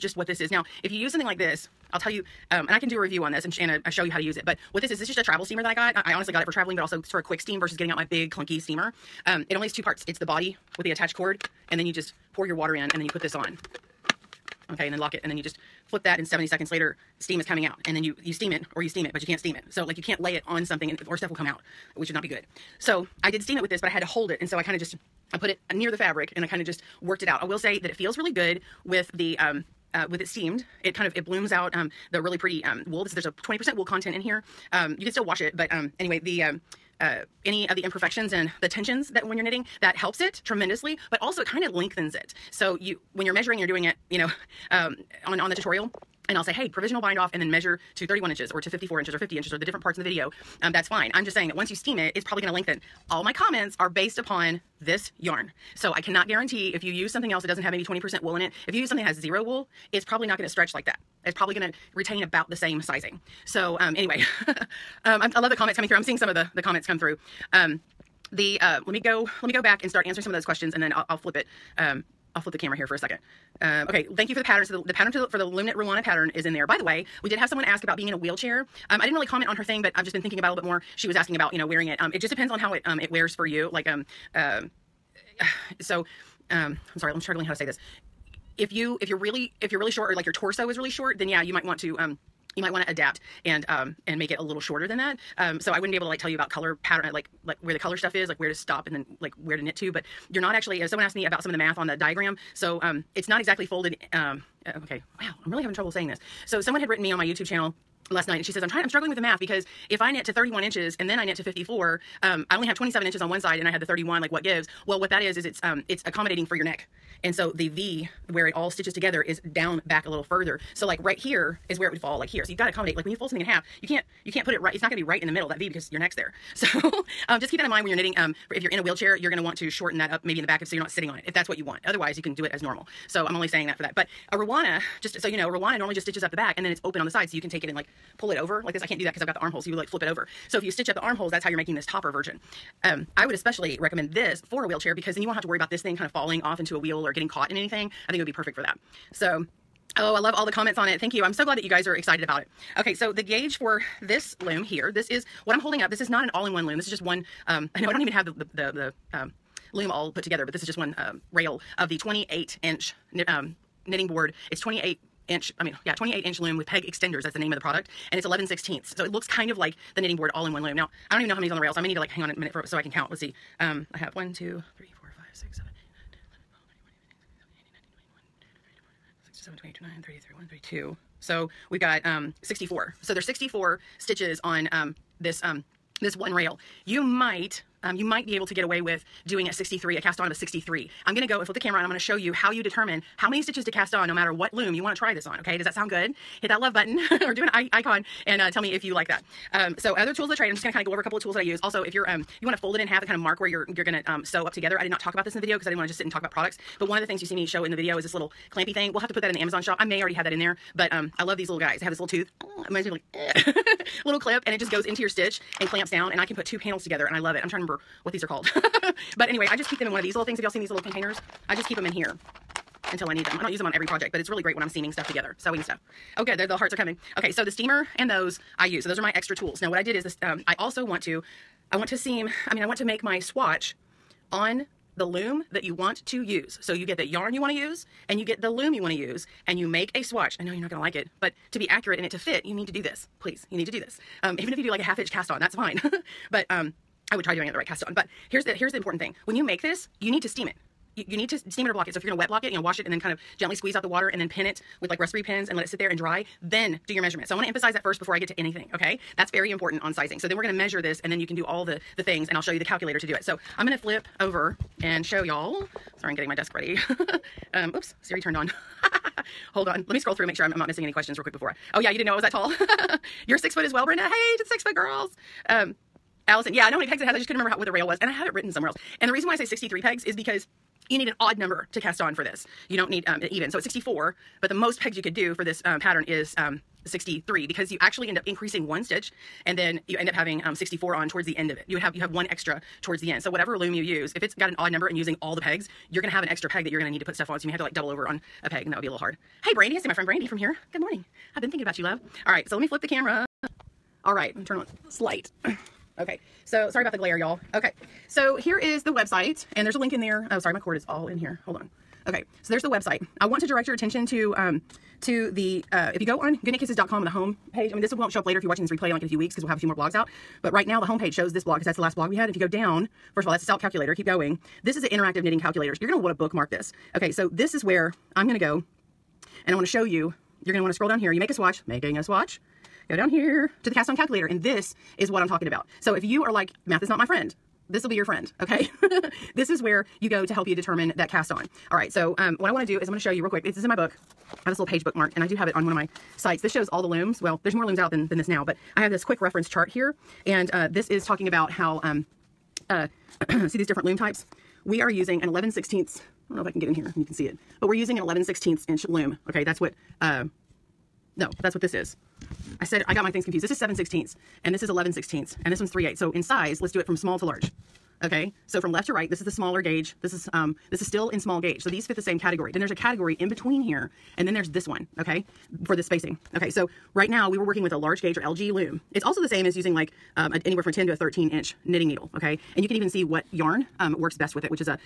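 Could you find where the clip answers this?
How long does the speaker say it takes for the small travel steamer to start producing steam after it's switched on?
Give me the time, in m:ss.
0:16.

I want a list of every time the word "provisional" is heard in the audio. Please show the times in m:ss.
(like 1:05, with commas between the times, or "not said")
0:46.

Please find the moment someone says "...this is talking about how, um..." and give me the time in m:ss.
5:50.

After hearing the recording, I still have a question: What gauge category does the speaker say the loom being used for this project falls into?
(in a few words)
large gauge.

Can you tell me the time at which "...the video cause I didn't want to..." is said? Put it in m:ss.
3:25.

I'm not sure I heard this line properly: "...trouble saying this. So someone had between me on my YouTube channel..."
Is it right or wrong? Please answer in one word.
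wrong.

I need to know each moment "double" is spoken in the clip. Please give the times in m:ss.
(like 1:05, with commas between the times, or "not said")
4:57.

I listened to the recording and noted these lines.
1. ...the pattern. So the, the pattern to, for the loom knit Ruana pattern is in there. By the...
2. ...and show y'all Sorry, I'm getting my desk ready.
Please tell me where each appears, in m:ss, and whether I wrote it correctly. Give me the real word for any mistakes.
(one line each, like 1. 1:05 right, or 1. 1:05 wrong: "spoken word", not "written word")
1. 1:14 right
2. 4:24 right.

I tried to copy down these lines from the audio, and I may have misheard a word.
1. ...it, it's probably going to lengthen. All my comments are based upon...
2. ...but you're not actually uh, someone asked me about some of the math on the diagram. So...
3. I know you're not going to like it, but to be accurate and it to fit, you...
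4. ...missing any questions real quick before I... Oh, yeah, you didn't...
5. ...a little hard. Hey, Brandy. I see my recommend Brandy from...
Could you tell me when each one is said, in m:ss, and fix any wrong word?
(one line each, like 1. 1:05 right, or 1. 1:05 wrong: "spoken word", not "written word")
1. 0:51 right
2. 1:39 right
3. 4:00 right
4. 4:30 right
5. 4:58 wrong: "friend", not "recommend".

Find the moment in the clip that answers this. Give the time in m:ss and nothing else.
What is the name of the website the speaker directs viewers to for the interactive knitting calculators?
5:16.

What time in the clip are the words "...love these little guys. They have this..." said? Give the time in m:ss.
3:31.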